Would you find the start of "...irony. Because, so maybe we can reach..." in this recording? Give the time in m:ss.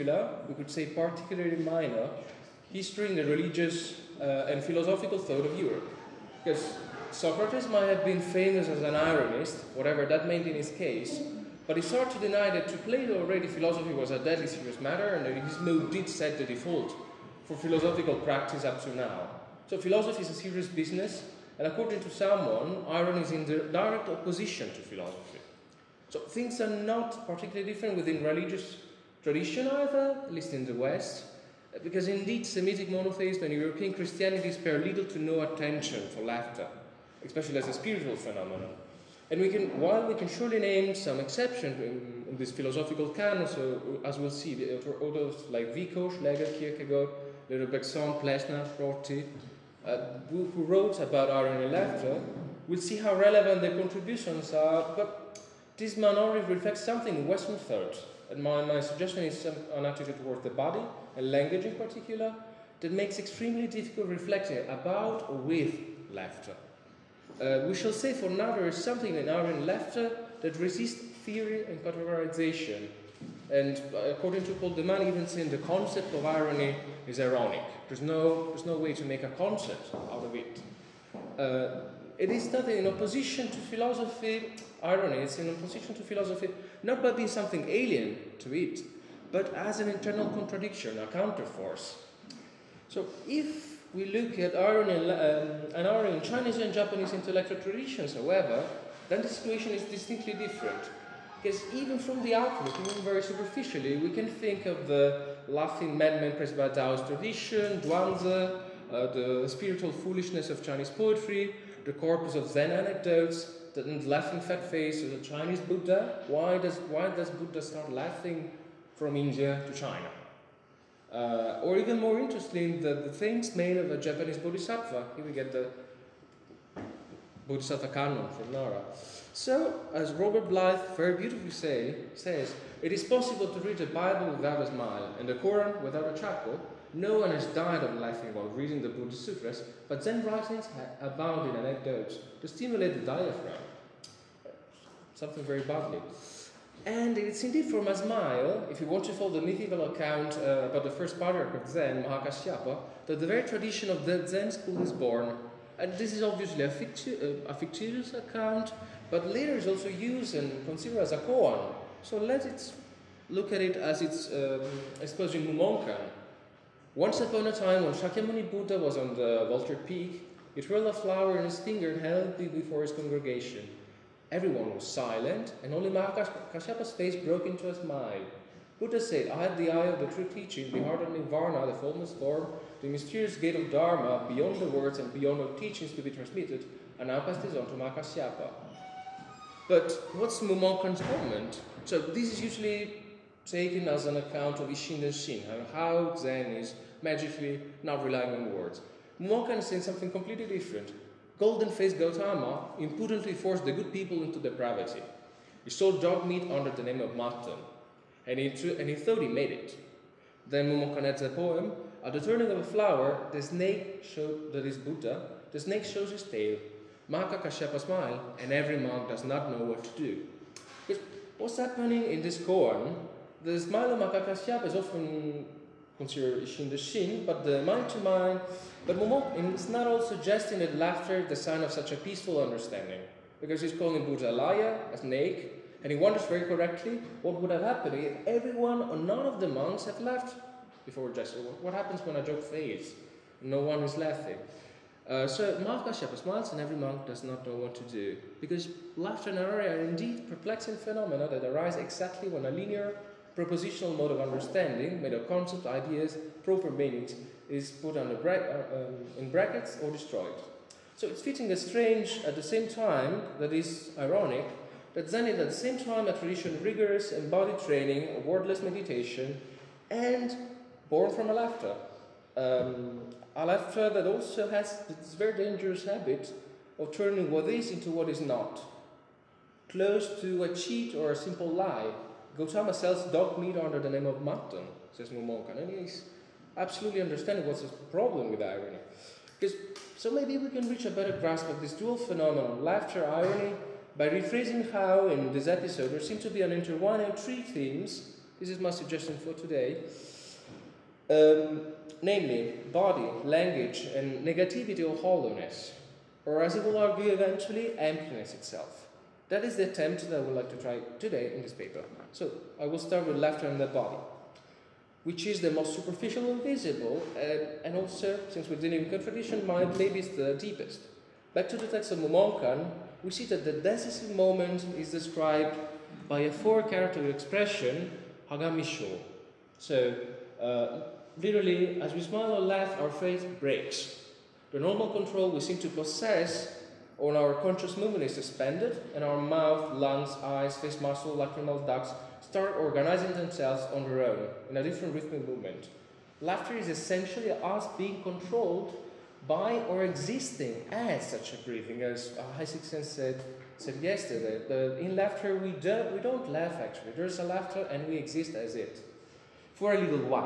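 4:48.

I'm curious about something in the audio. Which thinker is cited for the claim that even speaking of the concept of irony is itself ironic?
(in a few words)
Paul de Man.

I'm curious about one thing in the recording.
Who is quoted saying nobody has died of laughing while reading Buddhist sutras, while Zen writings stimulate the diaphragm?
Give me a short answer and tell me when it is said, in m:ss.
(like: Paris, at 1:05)
Robert Blyth, at 2:10.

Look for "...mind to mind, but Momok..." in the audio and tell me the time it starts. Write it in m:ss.
3:47.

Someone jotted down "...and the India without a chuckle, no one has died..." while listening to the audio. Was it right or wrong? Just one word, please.
wrong.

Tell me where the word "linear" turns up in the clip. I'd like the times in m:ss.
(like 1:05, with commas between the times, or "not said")
4:12.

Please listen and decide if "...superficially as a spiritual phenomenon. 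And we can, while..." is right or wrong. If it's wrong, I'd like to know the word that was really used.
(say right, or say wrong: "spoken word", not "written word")
wrong: "especially", not "superficially".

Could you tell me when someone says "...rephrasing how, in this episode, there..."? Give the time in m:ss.
4:54.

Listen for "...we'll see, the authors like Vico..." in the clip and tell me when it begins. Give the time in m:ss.
0:44.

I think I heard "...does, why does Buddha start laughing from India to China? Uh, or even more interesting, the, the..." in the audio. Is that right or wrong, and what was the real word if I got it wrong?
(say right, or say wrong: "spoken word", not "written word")
right.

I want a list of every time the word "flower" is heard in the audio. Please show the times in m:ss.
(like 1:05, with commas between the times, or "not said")
2:50, 3:32.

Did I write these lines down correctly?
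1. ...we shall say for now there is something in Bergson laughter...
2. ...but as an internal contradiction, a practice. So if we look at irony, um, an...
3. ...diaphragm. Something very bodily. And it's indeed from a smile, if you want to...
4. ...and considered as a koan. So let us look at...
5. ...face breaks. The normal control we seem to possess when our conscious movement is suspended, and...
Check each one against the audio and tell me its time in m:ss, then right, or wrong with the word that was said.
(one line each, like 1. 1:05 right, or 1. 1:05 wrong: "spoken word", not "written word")
1. 1:07 wrong: "Aryan", not "Bergson"
2. 1:29 wrong: "counterforce", not "practice"
3. 2:23 right
4. 2:40 right
5. 5:32 right.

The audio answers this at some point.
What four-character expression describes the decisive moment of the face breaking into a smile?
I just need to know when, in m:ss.
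5:28.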